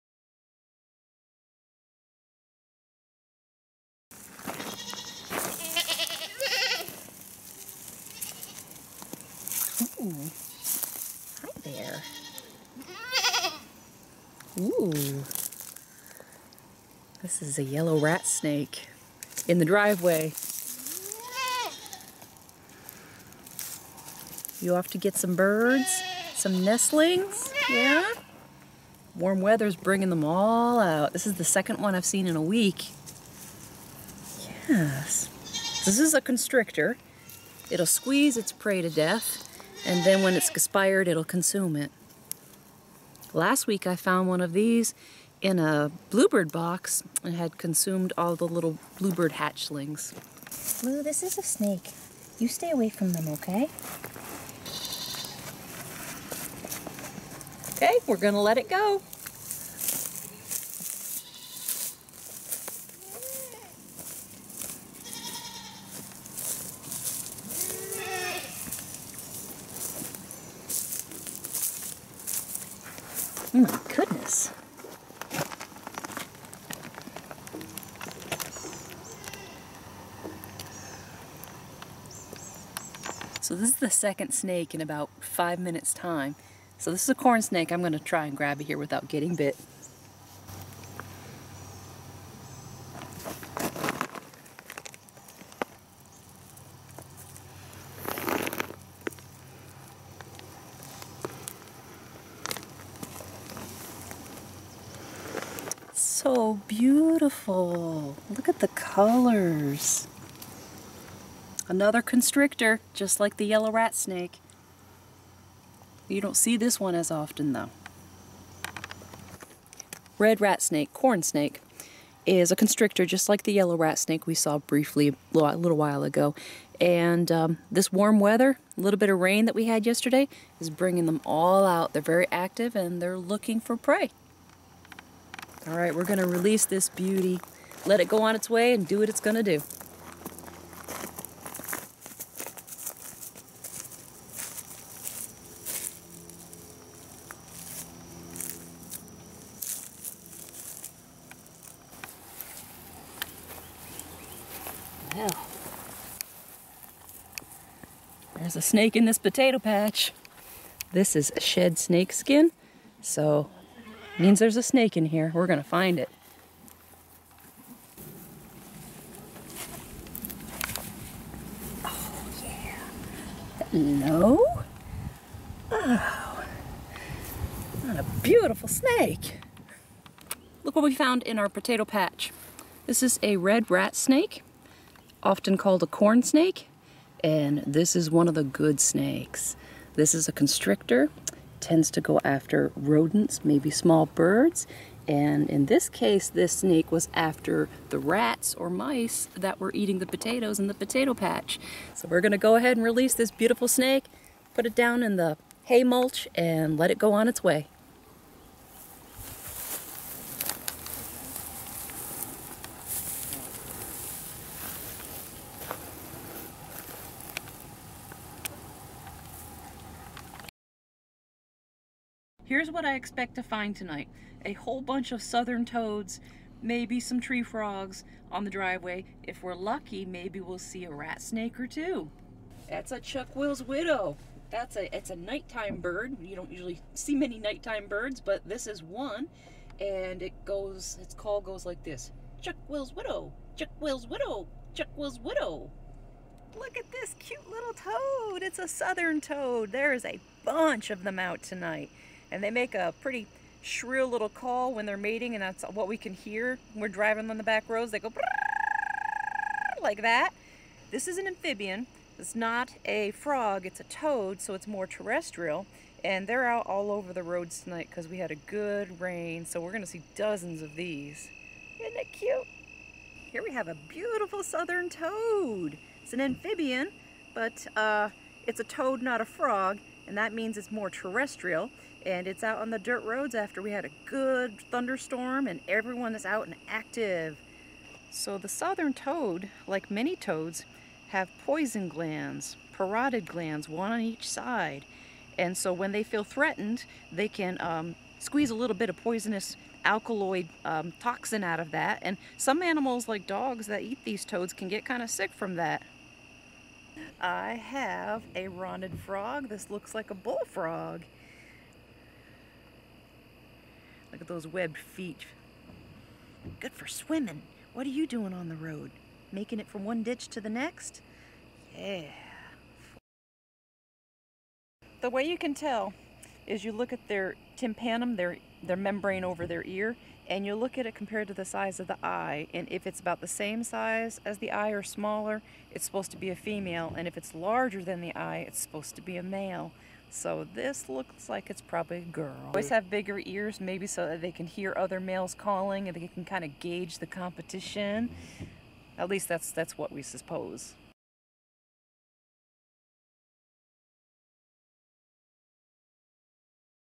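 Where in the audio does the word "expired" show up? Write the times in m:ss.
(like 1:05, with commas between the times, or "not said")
0:40.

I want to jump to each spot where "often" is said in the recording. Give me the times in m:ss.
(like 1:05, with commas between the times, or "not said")
1:57, 3:05.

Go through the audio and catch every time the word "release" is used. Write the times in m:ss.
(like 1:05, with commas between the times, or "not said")
2:16, 3:22.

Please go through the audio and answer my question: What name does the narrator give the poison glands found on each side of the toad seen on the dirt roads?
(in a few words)
parotid glands.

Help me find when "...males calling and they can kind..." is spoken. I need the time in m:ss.
5:44.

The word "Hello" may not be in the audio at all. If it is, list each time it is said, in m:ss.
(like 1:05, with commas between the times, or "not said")
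2:53.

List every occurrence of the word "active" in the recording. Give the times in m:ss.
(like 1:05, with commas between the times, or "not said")
2:12, 4:46.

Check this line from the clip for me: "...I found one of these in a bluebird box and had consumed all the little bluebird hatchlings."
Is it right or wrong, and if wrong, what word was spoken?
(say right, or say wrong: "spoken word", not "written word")
right.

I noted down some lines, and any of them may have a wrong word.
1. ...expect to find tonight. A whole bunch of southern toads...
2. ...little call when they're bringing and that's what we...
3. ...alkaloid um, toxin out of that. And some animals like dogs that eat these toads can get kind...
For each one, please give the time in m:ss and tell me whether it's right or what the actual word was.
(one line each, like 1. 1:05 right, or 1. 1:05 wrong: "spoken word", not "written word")
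1. 3:42 right
2. 4:14 wrong: "mating", not "bringing"
3. 4:59 right.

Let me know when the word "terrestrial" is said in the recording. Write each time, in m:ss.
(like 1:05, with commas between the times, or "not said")
4:24, 4:40.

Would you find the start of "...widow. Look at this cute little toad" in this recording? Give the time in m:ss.
4:05.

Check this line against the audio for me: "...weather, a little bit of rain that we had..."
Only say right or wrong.
right.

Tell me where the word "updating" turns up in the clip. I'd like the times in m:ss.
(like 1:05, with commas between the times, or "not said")
not said.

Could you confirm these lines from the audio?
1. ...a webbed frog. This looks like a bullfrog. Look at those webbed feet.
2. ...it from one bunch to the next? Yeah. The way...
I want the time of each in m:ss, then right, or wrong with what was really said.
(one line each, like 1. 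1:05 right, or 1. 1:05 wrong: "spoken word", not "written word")
1. 5:08 wrong: "rotted", not "webbed"
2. 5:19 wrong: "ditch", not "bunch".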